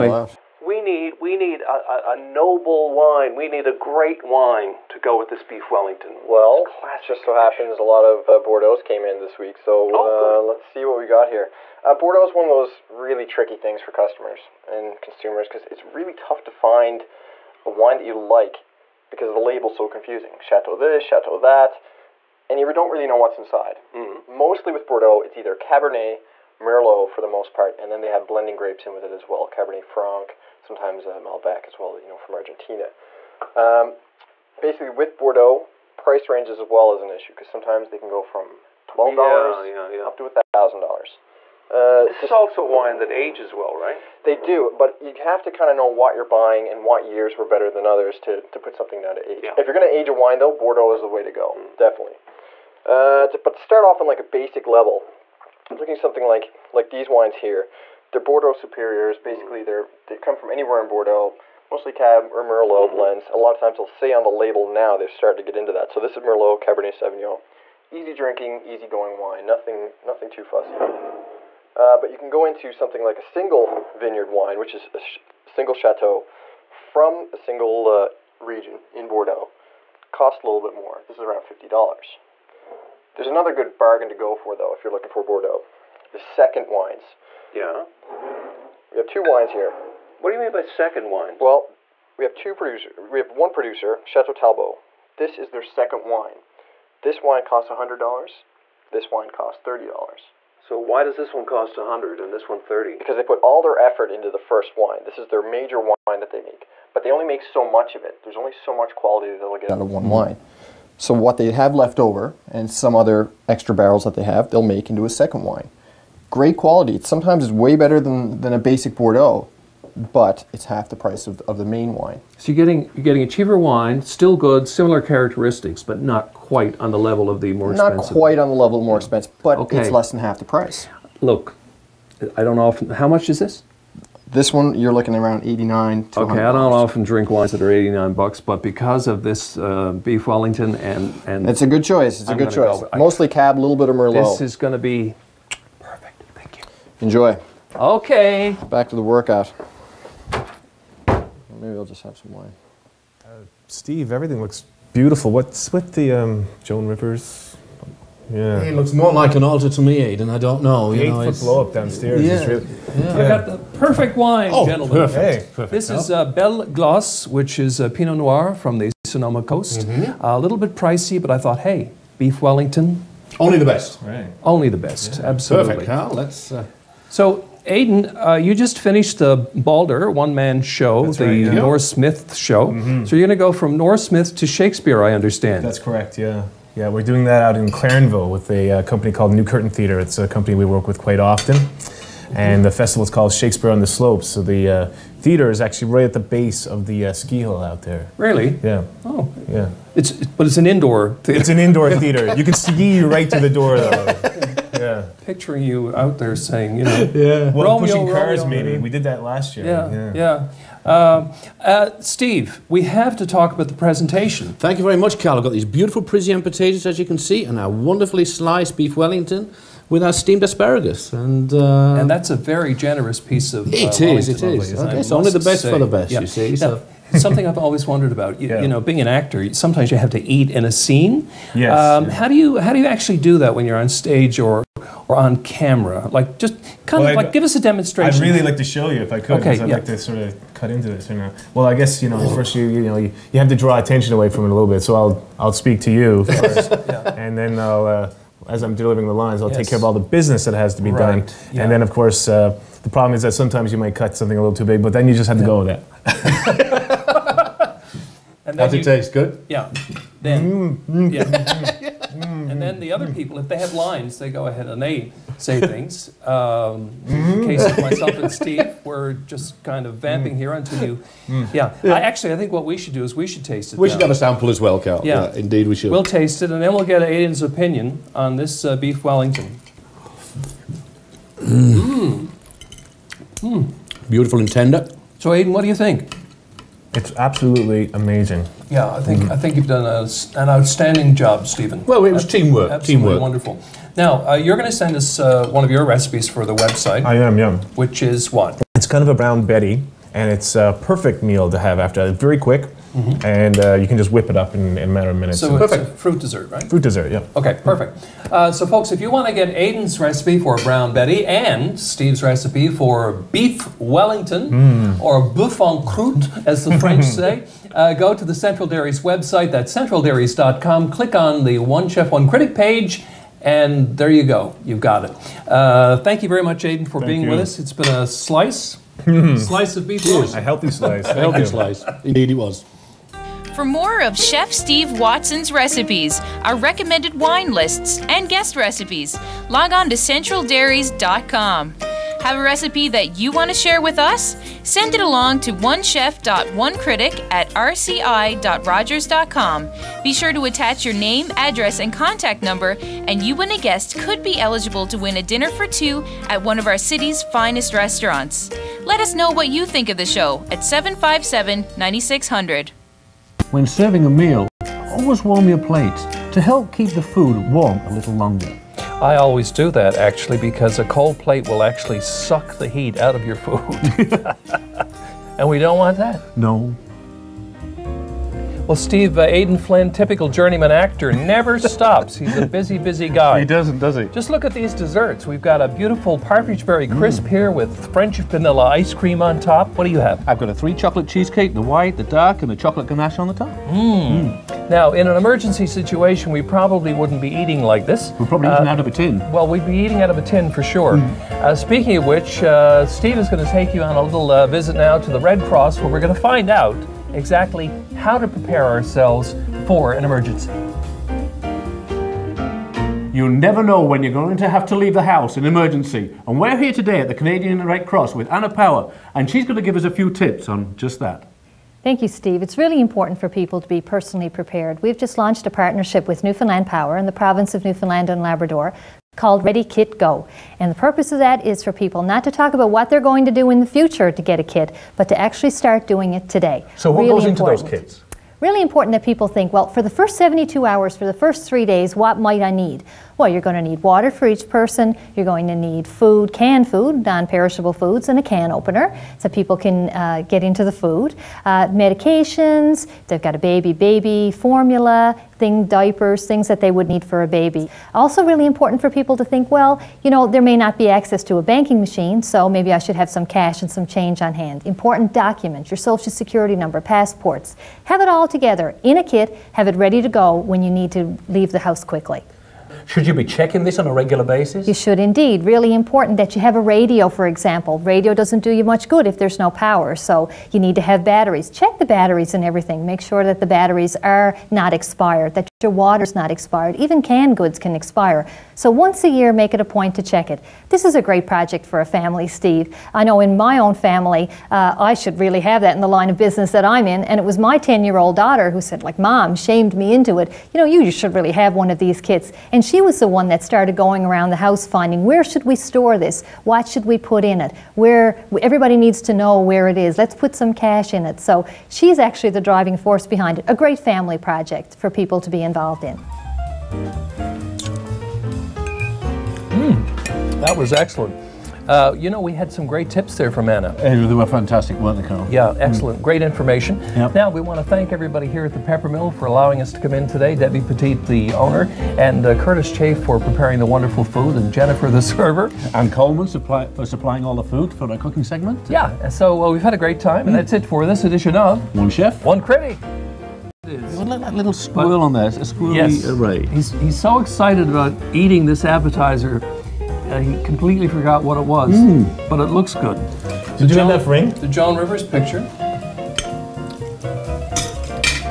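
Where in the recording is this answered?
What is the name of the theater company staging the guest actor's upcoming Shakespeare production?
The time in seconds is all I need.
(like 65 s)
189 s.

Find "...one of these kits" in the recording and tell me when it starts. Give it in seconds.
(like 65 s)
501 s.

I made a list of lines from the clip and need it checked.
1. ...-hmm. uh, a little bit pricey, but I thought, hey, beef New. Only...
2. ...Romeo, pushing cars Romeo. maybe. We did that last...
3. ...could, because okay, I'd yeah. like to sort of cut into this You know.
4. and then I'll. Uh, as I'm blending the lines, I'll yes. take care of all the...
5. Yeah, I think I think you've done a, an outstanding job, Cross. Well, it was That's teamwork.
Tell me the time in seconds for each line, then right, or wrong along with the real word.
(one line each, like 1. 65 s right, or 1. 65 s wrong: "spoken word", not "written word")
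1. 169 s wrong: "Wellington", not "New"
2. 207 s right
3. 239 s right
4. 247 s wrong: "delivering", not "blending"
5. 288 s wrong: "Stephen", not "Cross".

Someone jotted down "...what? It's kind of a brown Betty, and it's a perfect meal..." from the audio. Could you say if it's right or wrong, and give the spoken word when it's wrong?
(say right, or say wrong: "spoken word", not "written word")
right.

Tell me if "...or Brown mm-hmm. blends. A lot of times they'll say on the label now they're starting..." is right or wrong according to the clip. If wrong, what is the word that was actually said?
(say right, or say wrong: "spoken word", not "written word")
wrong: "Merlot", not "Brown".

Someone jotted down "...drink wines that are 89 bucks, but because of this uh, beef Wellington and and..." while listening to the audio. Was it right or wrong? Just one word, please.
right.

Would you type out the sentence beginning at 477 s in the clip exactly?
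Radio doesn't do you much good if there's no power, so you need to have batteries.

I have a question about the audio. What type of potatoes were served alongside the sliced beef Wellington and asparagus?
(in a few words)
Parisian potatoes.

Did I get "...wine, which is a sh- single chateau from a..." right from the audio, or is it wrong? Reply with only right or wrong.
right.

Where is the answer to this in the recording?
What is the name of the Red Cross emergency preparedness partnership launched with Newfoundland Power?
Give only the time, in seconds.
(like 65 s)
429 s.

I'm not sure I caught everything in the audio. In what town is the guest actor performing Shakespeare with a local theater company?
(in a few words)
Clarenville.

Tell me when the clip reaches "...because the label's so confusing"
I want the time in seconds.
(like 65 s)
19 s.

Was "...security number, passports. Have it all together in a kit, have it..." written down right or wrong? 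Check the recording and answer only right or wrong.
right.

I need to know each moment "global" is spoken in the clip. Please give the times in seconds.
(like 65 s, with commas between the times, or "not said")
not said.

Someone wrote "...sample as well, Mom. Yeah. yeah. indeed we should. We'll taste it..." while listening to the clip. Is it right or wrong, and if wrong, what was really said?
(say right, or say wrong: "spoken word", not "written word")
wrong: "Karl", not "Mom".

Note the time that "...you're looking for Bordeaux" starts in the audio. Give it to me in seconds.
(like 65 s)
84 s.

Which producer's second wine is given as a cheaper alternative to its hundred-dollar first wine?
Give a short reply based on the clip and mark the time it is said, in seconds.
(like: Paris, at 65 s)
Chateau Talbot, at 94 s.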